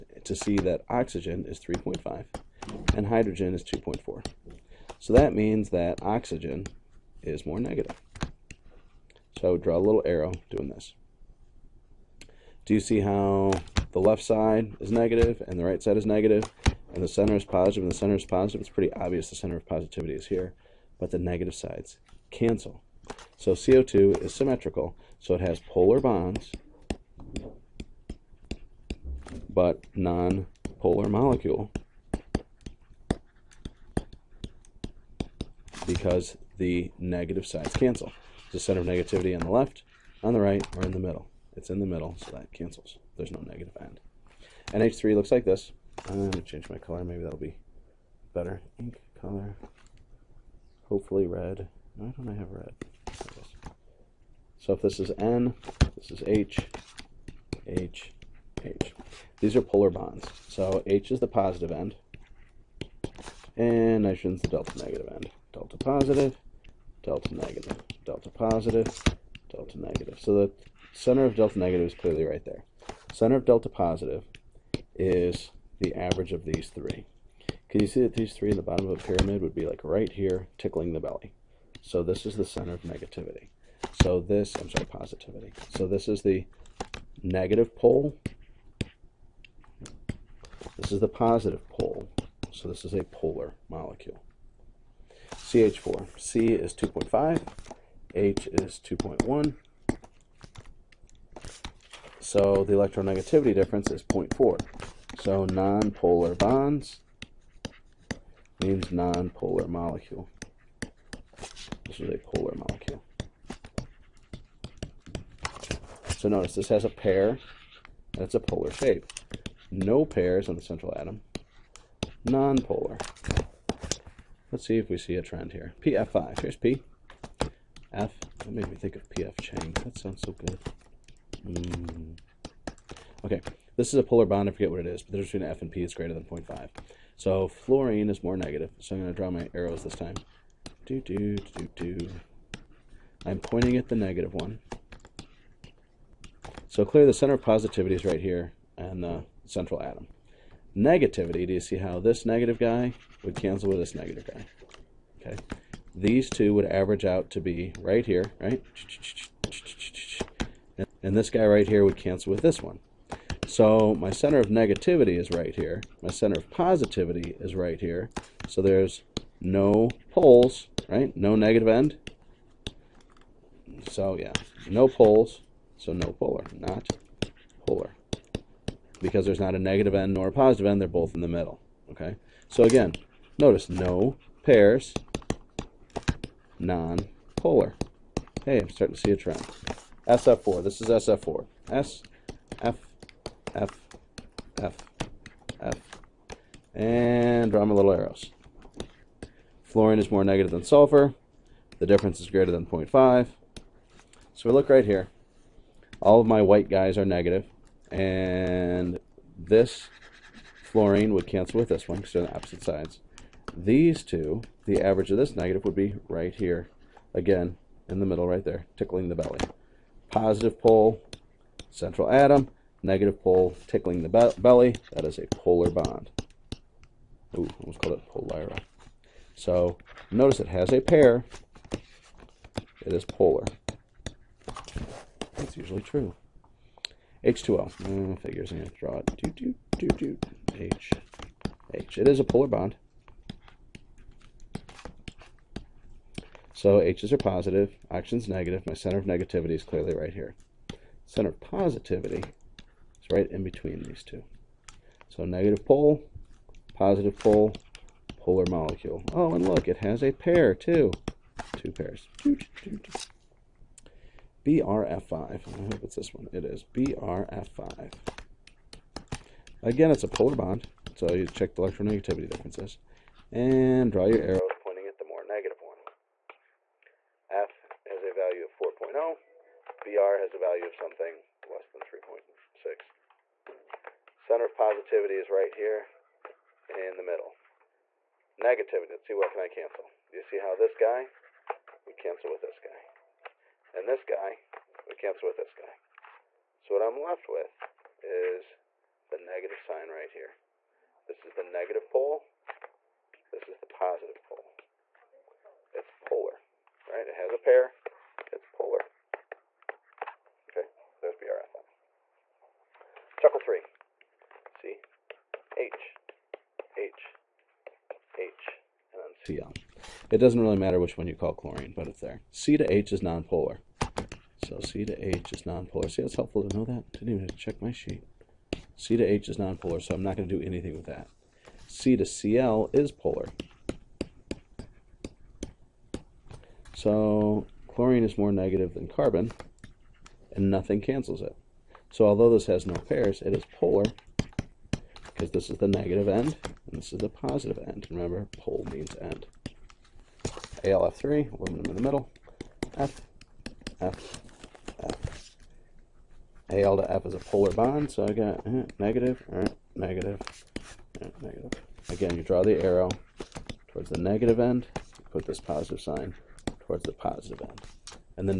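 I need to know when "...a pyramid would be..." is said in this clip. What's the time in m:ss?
1:18.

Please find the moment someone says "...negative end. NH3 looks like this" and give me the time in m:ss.
0:43.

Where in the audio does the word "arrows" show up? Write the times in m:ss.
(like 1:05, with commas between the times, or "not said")
0:10, 2:19, 3:17, 4:34, 6:02.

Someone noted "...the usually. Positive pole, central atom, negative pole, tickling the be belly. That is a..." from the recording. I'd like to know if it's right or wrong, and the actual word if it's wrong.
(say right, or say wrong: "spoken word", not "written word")
wrong: "belly", not "usually".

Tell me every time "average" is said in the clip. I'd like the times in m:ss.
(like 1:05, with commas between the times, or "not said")
1:15, 2:36, 3:34.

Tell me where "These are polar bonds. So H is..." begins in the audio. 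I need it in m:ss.
0:59.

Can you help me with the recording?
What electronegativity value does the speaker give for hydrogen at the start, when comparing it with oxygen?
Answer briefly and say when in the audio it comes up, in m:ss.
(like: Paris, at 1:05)
2.4, at 0:03.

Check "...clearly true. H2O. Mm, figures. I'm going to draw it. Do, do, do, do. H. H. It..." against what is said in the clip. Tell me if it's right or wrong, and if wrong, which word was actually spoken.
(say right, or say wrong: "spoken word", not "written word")
wrong: "usually", not "clearly".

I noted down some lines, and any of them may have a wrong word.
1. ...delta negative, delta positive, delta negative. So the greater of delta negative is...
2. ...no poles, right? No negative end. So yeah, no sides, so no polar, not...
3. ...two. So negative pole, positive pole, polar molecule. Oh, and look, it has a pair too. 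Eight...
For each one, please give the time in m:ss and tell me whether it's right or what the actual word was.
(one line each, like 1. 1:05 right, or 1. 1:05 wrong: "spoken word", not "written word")
1. 1:07 wrong: "center", not "greater"
2. 2:49 wrong: "poles", not "sides"
3. 4:14 wrong: "Two", not "Eight".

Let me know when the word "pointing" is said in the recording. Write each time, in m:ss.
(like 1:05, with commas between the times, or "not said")
2:23, 4:34.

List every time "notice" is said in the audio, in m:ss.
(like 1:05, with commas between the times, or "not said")
1:56, 3:03, 3:50.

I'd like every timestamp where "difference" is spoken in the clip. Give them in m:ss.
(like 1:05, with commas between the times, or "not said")
1:43, 2:15, 3:21, 4:32.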